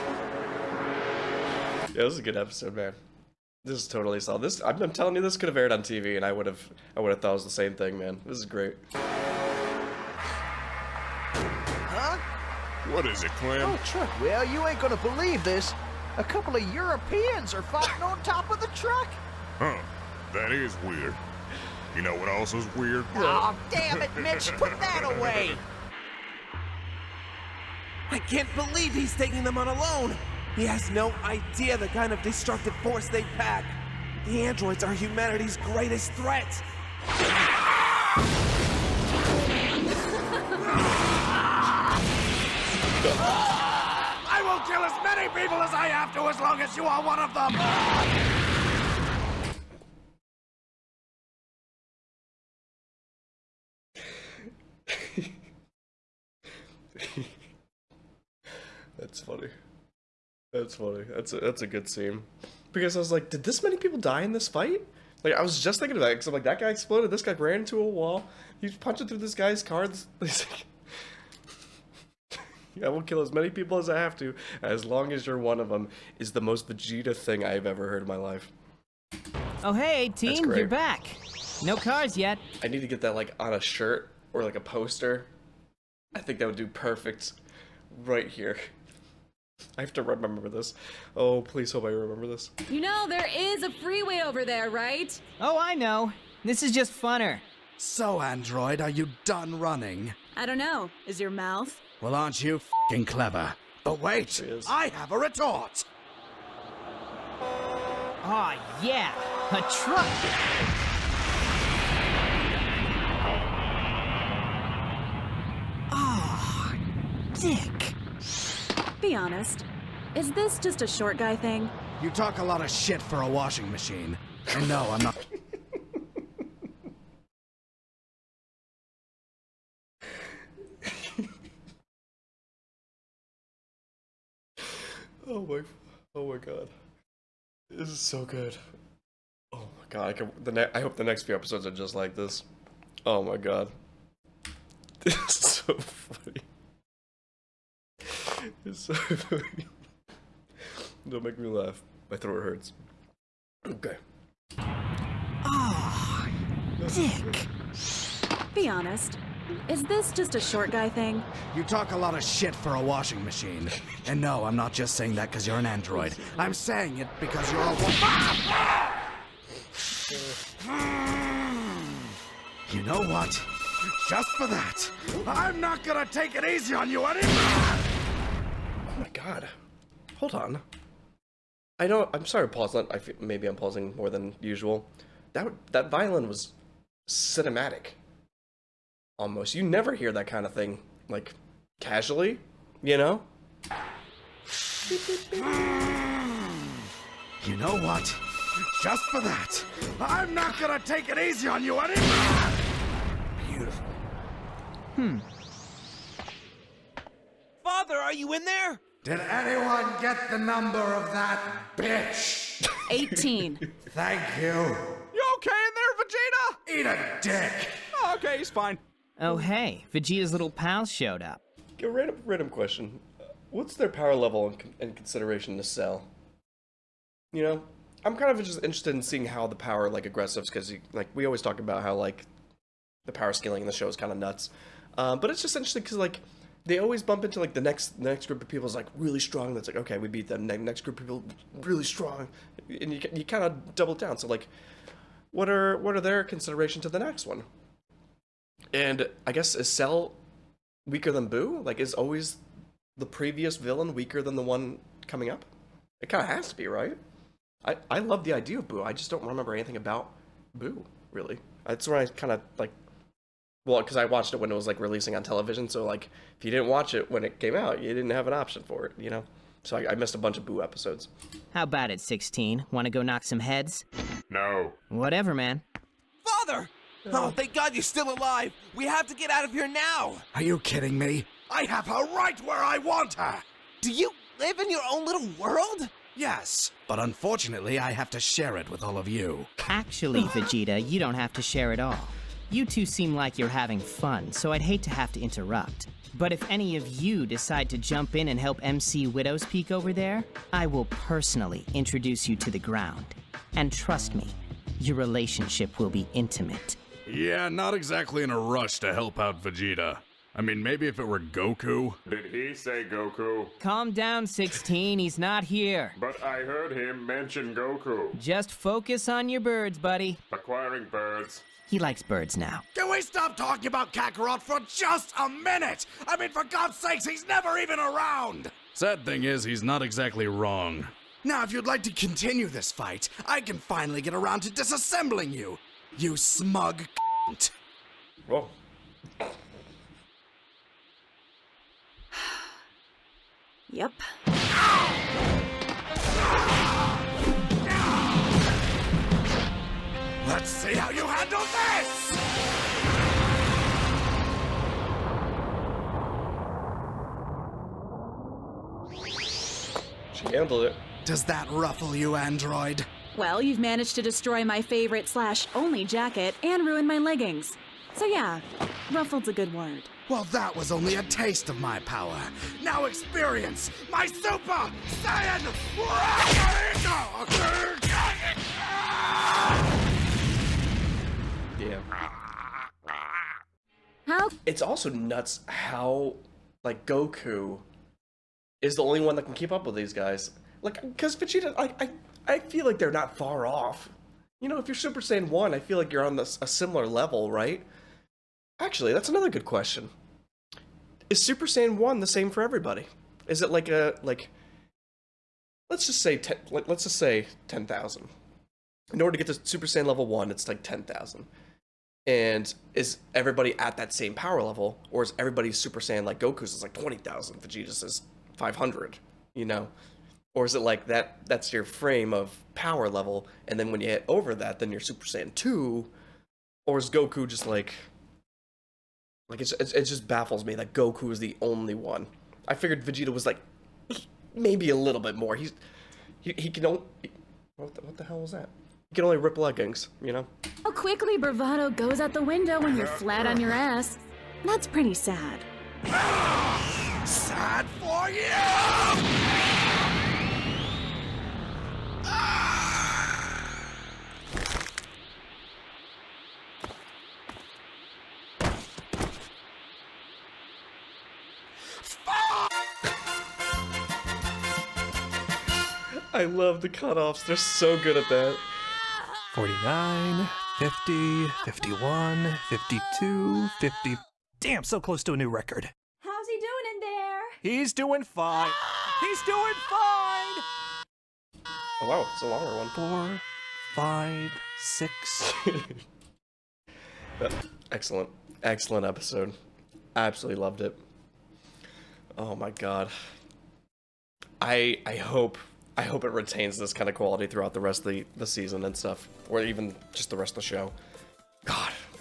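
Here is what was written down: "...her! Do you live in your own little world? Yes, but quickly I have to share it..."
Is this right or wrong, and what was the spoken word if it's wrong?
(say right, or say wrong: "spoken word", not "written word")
wrong: "unfortunately", not "quickly".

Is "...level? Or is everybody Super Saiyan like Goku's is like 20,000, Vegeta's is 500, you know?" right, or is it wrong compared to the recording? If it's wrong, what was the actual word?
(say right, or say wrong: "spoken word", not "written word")
right.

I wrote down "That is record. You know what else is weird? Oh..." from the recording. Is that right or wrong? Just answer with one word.
wrong.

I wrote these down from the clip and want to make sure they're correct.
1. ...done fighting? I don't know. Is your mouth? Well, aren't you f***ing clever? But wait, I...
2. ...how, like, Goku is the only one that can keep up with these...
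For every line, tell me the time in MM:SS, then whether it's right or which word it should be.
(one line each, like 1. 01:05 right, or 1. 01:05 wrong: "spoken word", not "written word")
1. 01:39 wrong: "running", not "fighting"
2. 06:25 right.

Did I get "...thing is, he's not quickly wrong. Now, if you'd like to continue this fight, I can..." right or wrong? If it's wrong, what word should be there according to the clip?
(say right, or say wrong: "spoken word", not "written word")
wrong: "exactly", not "quickly".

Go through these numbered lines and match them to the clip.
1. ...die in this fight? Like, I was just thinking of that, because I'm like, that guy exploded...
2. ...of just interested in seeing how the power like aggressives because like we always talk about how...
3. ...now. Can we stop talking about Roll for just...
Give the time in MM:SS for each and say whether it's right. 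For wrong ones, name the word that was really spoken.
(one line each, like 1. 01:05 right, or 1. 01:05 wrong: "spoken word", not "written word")
1. 01:03 right
2. 03:48 right
3. 05:22 wrong: "Kakarot", not "Roll".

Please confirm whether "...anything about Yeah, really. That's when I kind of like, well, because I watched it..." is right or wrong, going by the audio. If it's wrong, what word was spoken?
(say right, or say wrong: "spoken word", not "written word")
wrong: "Boo", not "Yeah".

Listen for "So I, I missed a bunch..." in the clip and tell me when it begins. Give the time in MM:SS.
04:29.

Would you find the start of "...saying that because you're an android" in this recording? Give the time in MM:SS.
02:44.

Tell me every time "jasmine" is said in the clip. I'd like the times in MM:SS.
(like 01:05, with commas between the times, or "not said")
not said.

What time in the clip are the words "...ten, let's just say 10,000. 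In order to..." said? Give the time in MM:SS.
06:46.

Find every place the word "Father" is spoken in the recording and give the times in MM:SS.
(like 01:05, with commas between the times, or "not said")
03:27, 04:36.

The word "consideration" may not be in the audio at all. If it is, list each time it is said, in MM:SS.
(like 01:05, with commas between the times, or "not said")
03:44, 04:06.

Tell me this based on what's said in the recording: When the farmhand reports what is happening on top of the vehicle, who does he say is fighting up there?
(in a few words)
A couple of Europeans.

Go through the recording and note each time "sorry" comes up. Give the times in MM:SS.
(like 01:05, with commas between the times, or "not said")
03:02.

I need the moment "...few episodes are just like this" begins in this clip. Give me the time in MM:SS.
02:21.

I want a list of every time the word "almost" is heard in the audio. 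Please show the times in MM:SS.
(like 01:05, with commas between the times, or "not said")
03:09.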